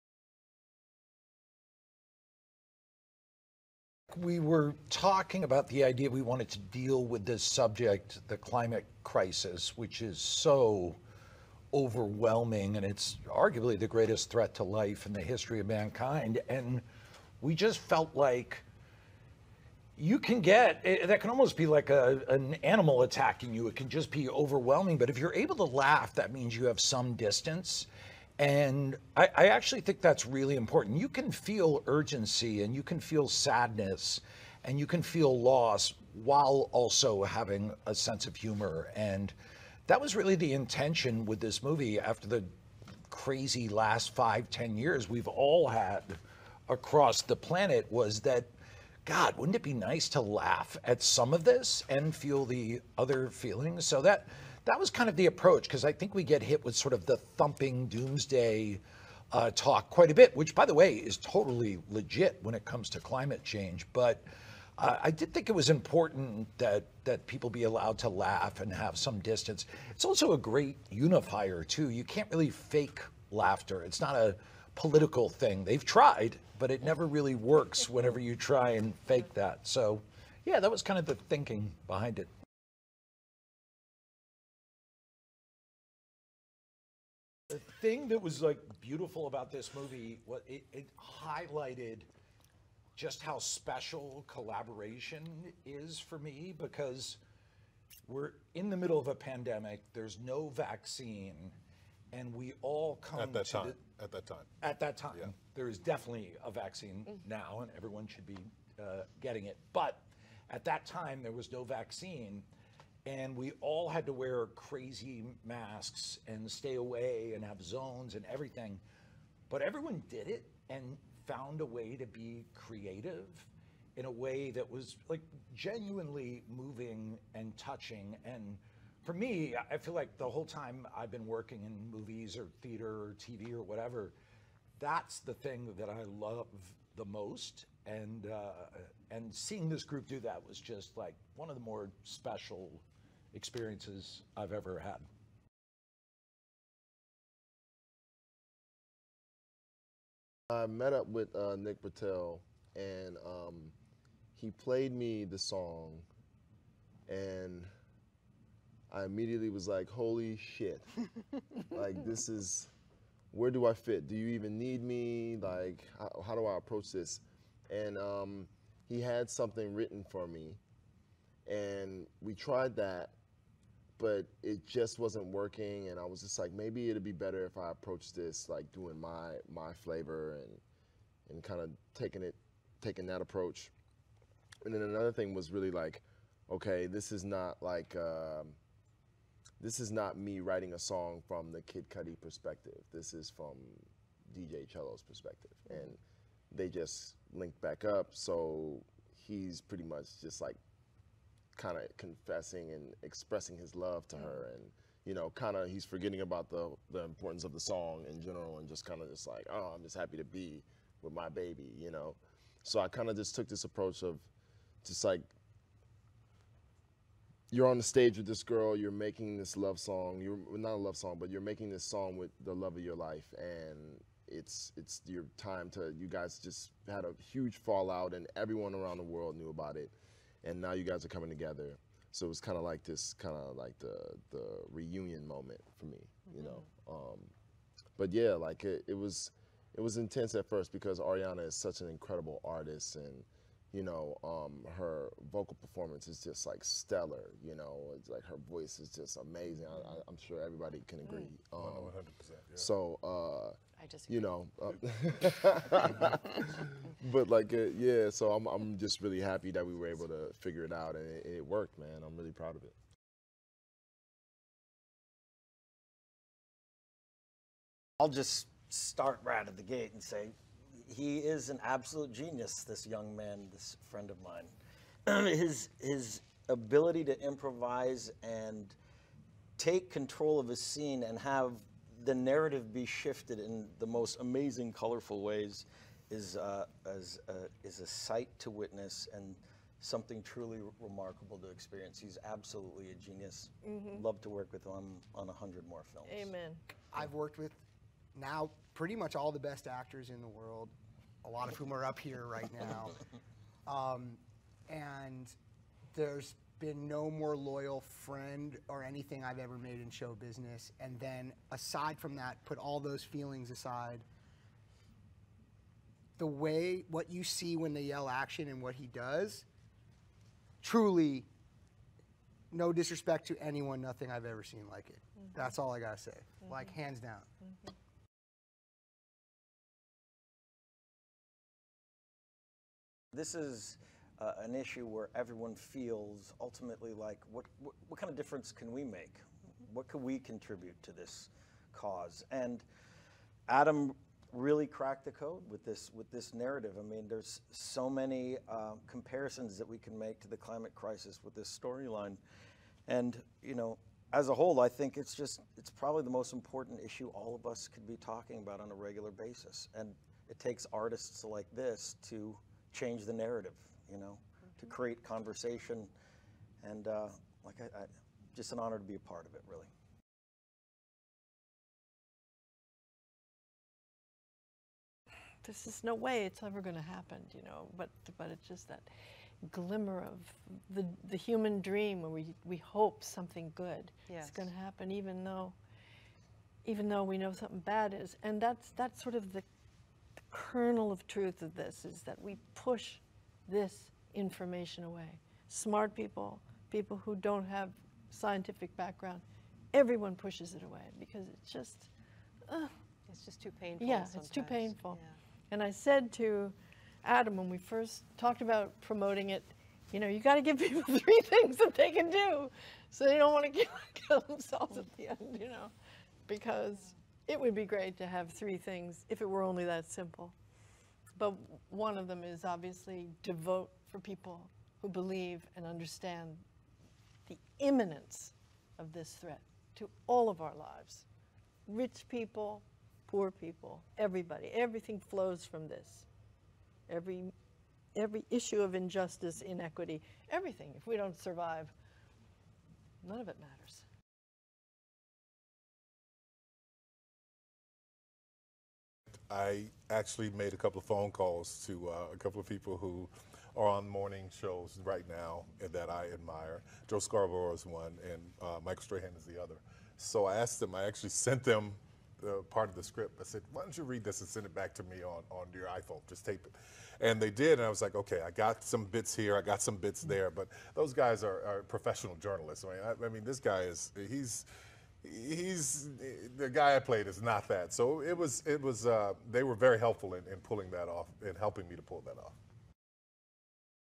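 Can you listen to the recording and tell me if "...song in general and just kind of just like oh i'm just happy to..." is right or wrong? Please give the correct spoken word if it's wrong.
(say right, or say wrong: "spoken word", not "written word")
right.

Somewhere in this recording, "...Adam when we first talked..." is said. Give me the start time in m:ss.
6:47.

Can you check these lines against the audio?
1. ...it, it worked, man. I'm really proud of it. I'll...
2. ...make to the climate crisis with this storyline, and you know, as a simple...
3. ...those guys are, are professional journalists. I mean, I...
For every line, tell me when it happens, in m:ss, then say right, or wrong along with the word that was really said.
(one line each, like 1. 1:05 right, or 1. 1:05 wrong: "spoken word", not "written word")
1. 4:21 right
2. 5:49 wrong: "whole", not "simple"
3. 7:50 right.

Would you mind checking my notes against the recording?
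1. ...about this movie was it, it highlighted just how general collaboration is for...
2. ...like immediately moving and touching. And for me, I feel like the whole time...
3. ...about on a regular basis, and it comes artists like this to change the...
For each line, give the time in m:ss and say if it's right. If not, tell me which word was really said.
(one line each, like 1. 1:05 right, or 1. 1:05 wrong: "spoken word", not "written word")
1. 1:29 wrong: "special", not "general"
2. 2:05 wrong: "genuinely", not "immediately"
3. 5:58 wrong: "takes", not "comes".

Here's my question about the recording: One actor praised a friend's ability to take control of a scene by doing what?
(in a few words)
improvise.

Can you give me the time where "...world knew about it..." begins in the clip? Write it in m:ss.
3:49.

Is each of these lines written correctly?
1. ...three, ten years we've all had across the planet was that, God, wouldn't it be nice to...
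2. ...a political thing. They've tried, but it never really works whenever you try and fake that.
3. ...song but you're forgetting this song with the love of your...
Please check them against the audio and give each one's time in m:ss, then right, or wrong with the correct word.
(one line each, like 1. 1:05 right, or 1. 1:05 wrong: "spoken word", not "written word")
1. 0:44 wrong: "five", not "three"
2. 1:14 right
3. 3:40 wrong: "making", not "forgetting".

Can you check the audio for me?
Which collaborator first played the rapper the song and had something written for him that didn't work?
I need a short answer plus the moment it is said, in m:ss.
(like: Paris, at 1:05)
Nick Britell, at 2:31.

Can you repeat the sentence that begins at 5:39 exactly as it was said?
What can we contribute to this cause?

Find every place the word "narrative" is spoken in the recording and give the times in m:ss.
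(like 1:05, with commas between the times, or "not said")
4:42, 5:46, 6:03.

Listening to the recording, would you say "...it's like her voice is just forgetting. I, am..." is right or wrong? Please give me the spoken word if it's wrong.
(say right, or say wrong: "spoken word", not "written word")
wrong: "amazing", not "forgetting".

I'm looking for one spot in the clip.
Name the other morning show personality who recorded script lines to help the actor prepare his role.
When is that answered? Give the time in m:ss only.
7:38.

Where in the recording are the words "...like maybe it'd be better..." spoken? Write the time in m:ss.
2:56.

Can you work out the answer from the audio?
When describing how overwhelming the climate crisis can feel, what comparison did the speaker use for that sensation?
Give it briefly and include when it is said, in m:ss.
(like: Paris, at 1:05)
an animal attacking you, at 0:22.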